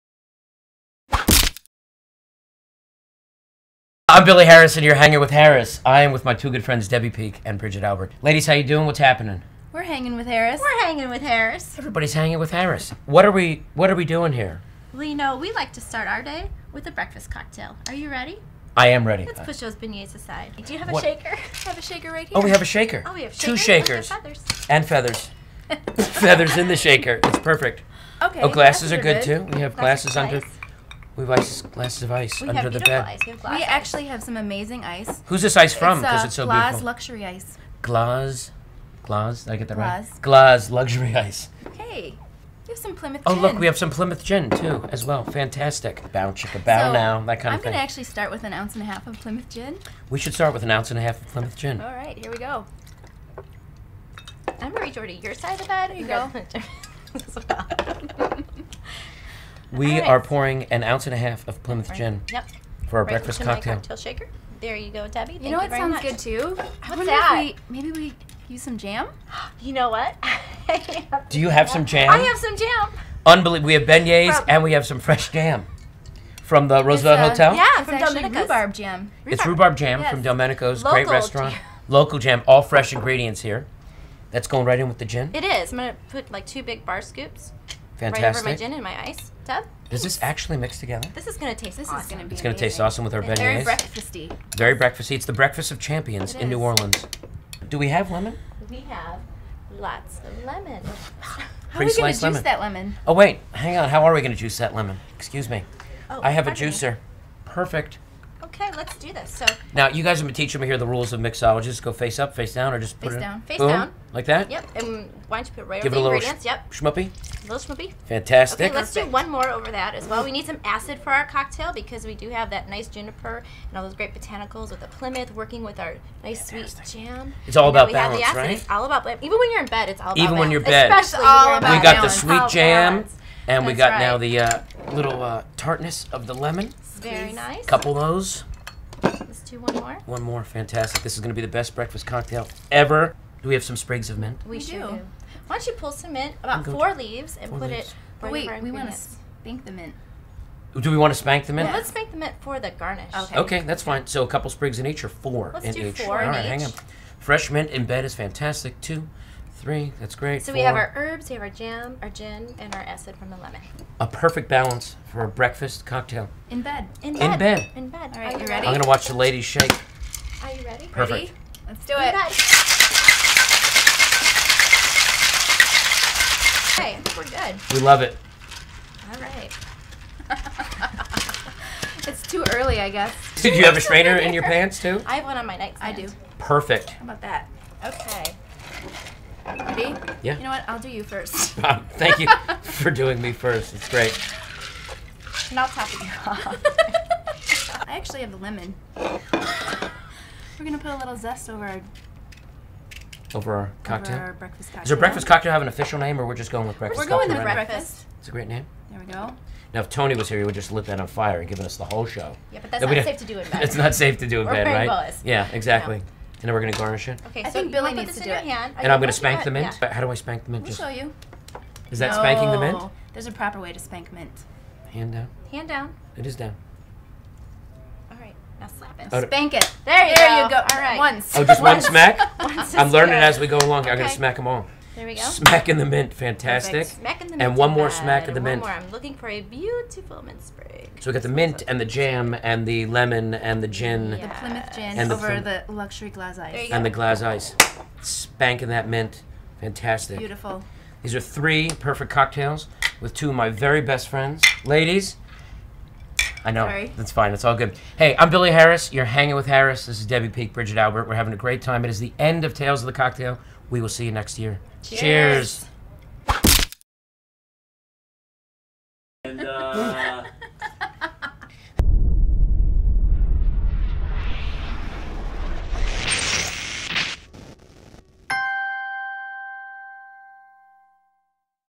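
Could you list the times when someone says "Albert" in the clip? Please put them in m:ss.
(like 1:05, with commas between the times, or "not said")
0:07, 4:20.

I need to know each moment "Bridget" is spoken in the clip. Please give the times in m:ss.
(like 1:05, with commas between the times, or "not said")
0:07, 4:20.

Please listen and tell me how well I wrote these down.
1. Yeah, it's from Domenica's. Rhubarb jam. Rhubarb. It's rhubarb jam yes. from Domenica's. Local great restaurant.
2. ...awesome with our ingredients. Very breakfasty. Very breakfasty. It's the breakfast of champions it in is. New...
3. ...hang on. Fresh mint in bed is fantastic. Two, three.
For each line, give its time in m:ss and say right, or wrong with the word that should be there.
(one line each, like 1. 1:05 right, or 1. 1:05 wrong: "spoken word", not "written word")
1. 1:17 right
2. 1:32 wrong: "beignets", not "ingredients"
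3. 2:36 right.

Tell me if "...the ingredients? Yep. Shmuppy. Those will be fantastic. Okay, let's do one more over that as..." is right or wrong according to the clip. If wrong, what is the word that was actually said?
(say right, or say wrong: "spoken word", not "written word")
right.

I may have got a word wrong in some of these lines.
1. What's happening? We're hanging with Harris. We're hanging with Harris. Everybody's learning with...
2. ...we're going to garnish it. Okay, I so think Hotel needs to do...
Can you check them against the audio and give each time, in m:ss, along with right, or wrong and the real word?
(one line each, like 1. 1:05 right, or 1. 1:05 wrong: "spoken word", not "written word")
1. 0:08 wrong: "hanging", not "learning"
2. 3:36 wrong: "Billy", not "Hotel".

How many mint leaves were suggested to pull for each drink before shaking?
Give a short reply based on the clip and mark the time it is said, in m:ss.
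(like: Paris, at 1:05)
4, at 2:26.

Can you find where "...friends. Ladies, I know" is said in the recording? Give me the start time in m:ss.
4:14.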